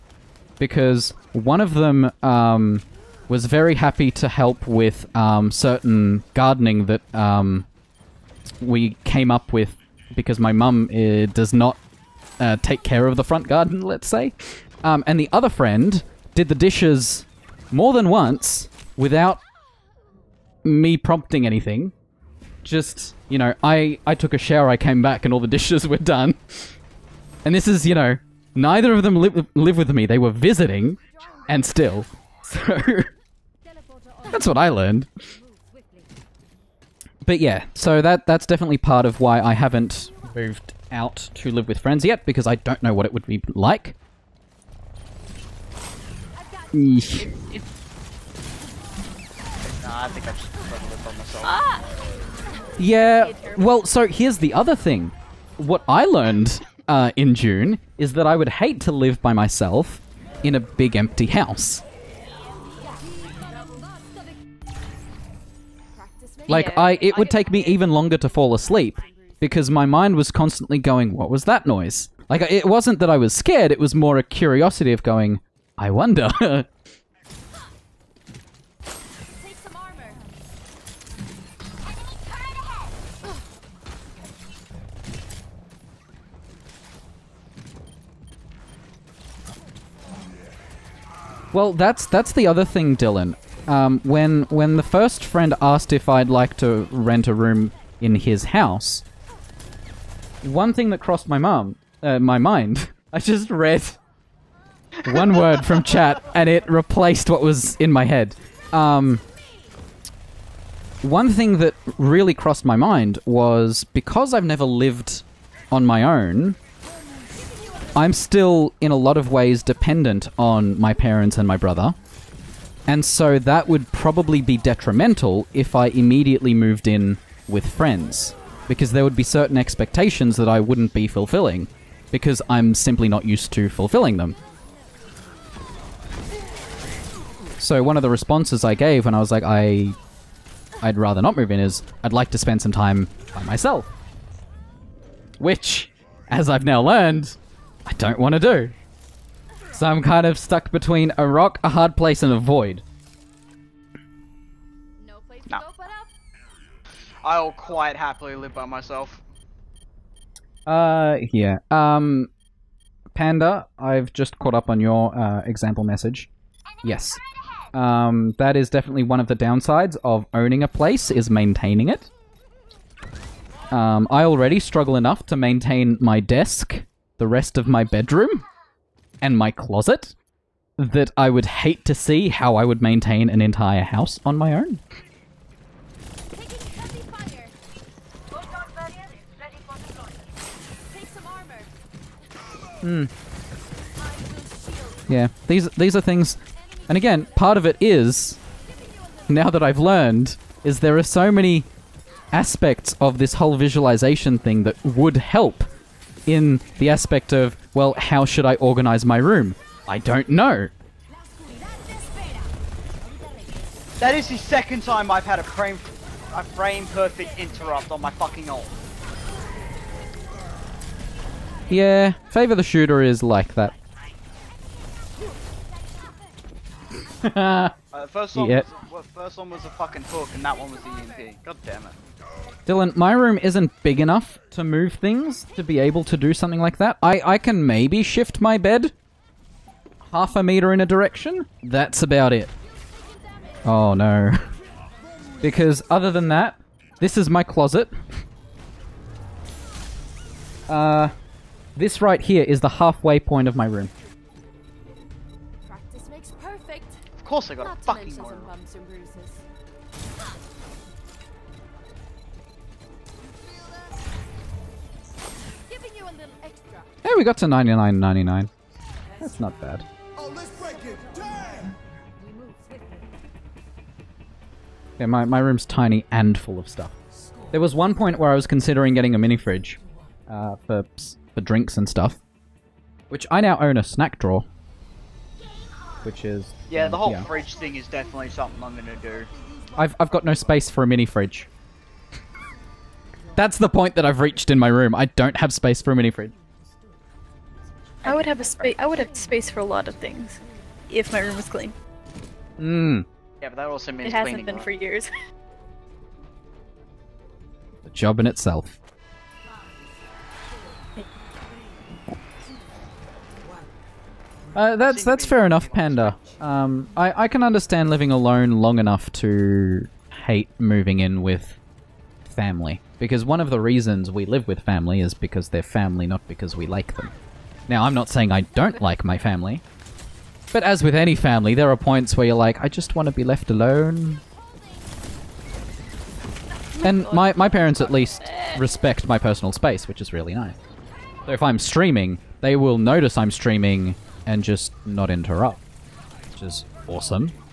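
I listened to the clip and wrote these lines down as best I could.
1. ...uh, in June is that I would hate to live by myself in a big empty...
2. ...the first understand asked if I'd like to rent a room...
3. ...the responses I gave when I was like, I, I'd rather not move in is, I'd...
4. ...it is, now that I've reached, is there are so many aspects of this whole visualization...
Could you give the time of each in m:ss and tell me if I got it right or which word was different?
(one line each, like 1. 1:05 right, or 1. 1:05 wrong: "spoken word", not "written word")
1. 0:56 right
2. 1:34 wrong: "friend", not "understand"
3. 2:18 right
4. 3:17 wrong: "learned", not "reached".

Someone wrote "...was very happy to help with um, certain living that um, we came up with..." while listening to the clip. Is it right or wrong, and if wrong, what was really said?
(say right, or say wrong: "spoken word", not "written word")
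wrong: "gardening", not "living".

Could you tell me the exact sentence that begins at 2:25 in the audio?
Which, as I've now learned, I don't want to do.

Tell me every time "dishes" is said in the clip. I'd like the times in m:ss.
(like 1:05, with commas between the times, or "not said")
0:16, 0:25.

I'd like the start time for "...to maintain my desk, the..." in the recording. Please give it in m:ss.
2:55.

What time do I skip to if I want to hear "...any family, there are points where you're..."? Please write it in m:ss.
5:30.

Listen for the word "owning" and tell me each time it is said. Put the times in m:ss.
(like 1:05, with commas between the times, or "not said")
2:50.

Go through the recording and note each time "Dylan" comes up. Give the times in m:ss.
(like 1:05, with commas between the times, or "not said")
1:32, 3:52.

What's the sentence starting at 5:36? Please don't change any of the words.
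And my, my parents at least respect my personal space, which is really nice.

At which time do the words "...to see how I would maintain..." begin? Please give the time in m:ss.
3:01.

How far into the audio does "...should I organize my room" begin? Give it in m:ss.
3:28.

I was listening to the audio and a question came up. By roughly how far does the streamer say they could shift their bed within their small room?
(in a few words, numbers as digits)
half a meter.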